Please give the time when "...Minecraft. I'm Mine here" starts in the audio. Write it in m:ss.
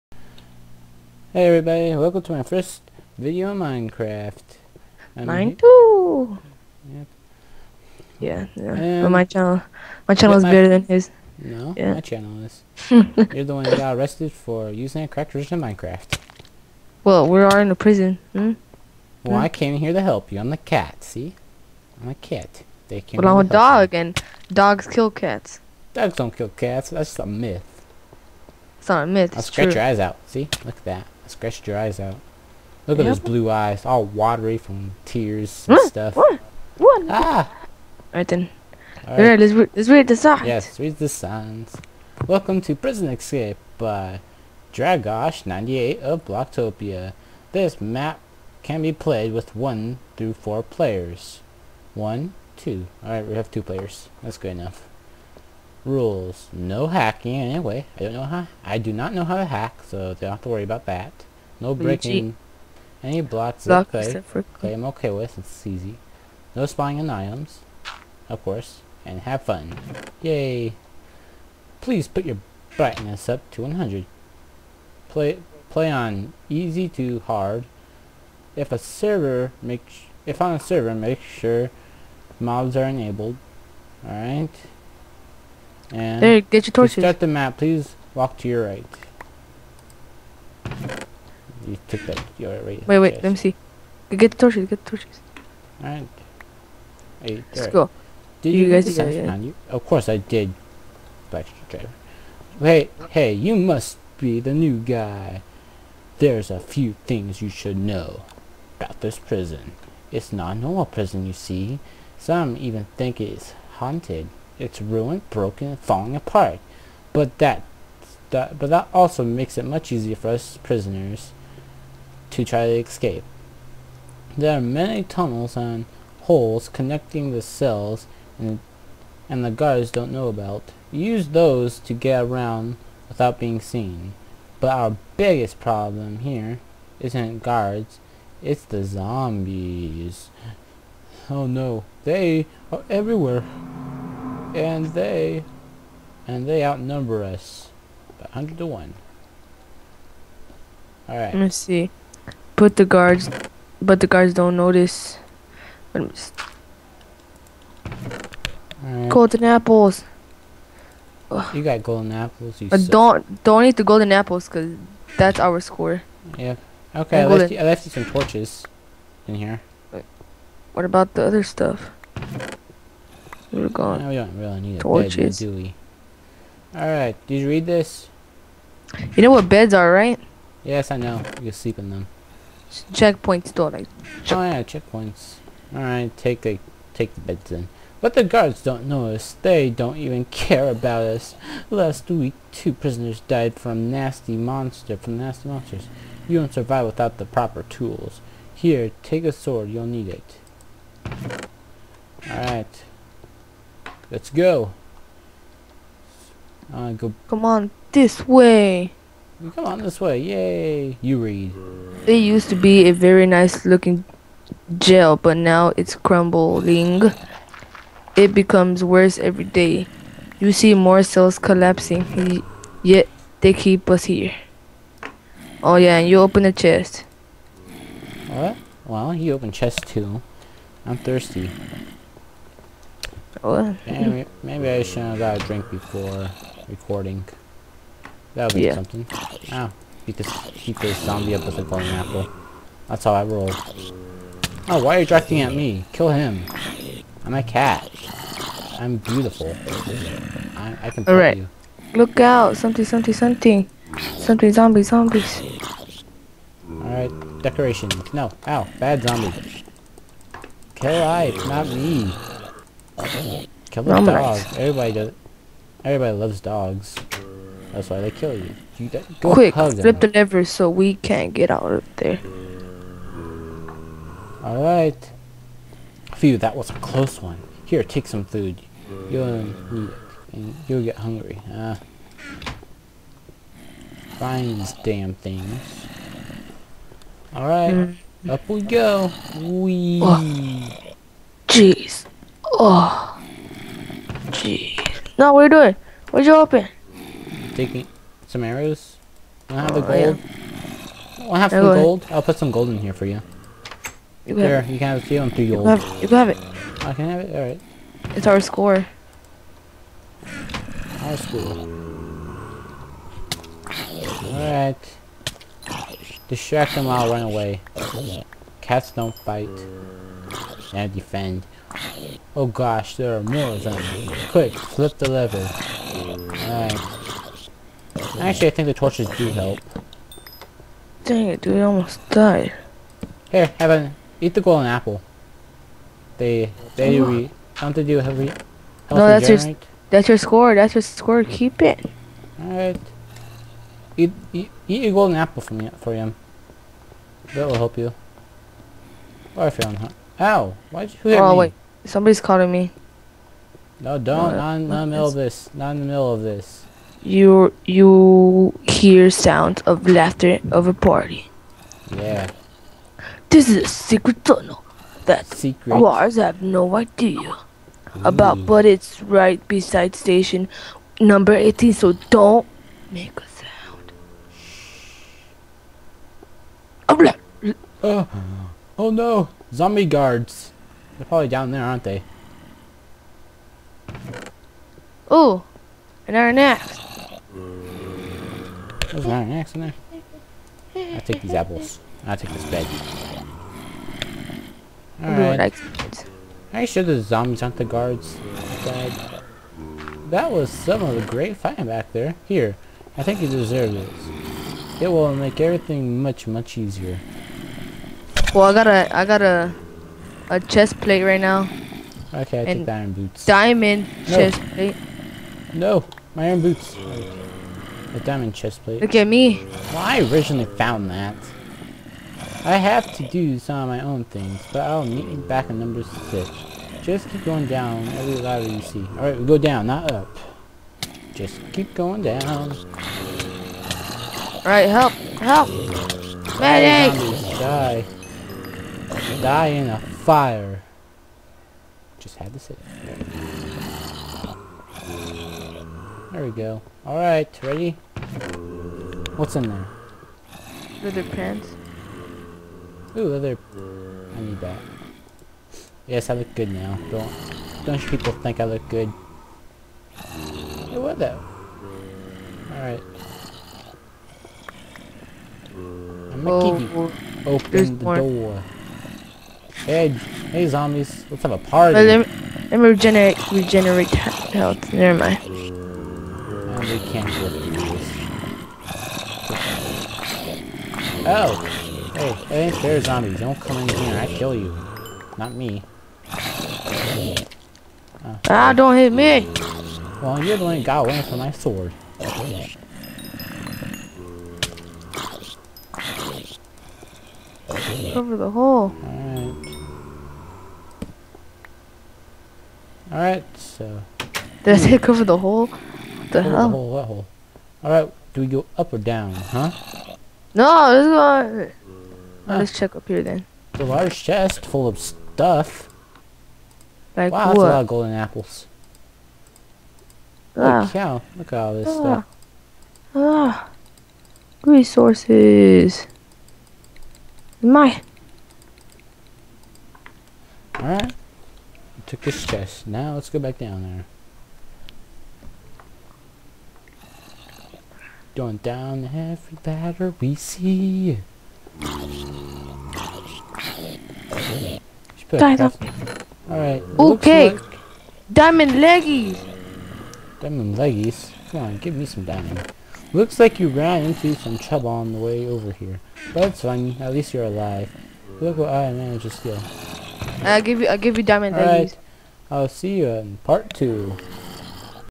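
0:03.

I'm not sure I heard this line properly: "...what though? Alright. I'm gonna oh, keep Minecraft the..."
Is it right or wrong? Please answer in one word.
wrong.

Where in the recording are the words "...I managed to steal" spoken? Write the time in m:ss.
9:18.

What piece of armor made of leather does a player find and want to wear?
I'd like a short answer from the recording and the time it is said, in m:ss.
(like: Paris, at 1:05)
Leather pants, at 7:30.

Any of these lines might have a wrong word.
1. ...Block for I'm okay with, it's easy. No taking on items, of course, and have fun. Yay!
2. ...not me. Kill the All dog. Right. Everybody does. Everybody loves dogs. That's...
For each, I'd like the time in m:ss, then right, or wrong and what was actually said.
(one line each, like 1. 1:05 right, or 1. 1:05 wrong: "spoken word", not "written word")
1. 1:03 wrong: "spying", not "taking"
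2. 4:21 right.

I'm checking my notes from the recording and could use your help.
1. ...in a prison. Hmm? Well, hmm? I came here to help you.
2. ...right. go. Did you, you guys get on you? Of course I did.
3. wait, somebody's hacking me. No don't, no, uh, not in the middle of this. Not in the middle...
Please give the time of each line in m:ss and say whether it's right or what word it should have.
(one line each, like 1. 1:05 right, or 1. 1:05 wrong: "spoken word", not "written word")
1. 0:17 right
2. 1:37 right
3. 5:51 wrong: "calling", not "hacking".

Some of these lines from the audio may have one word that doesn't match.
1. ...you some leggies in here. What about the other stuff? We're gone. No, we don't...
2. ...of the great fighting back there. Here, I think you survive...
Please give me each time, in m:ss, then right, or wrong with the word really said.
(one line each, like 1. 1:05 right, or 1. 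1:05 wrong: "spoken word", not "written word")
1. 2:47 wrong: "torches", not "leggies"
2. 6:40 wrong: "deserve", not "survive".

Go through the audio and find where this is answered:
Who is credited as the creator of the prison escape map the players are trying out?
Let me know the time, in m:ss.
0:44.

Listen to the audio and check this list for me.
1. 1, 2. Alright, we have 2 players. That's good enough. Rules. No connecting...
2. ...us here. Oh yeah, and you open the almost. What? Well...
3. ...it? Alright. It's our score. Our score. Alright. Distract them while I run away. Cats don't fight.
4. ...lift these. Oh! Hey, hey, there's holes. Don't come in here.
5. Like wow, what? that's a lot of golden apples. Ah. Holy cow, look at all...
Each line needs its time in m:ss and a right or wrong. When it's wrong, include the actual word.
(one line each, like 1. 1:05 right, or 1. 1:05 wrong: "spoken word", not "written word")
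1. 0:51 wrong: "hacking", not "connecting"
2. 3:43 wrong: "chest", not "almost"
3. 5:07 right
4. 7:57 wrong: "zombies", not "holes"
5. 8:36 right.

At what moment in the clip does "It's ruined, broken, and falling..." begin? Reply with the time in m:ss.
1:54.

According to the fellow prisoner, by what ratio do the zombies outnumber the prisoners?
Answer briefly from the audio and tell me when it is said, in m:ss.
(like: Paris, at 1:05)
100 to 1, at 2:28.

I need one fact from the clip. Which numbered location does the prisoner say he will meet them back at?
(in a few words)
Number 6.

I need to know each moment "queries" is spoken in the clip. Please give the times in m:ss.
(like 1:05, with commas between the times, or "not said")
not said.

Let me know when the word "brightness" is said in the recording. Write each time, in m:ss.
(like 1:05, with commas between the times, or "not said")
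1:12.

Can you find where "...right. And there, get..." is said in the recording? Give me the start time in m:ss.
1:24.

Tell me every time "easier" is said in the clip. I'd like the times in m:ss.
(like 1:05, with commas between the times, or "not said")
1:59, 6:46.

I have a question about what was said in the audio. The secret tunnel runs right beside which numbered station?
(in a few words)
18.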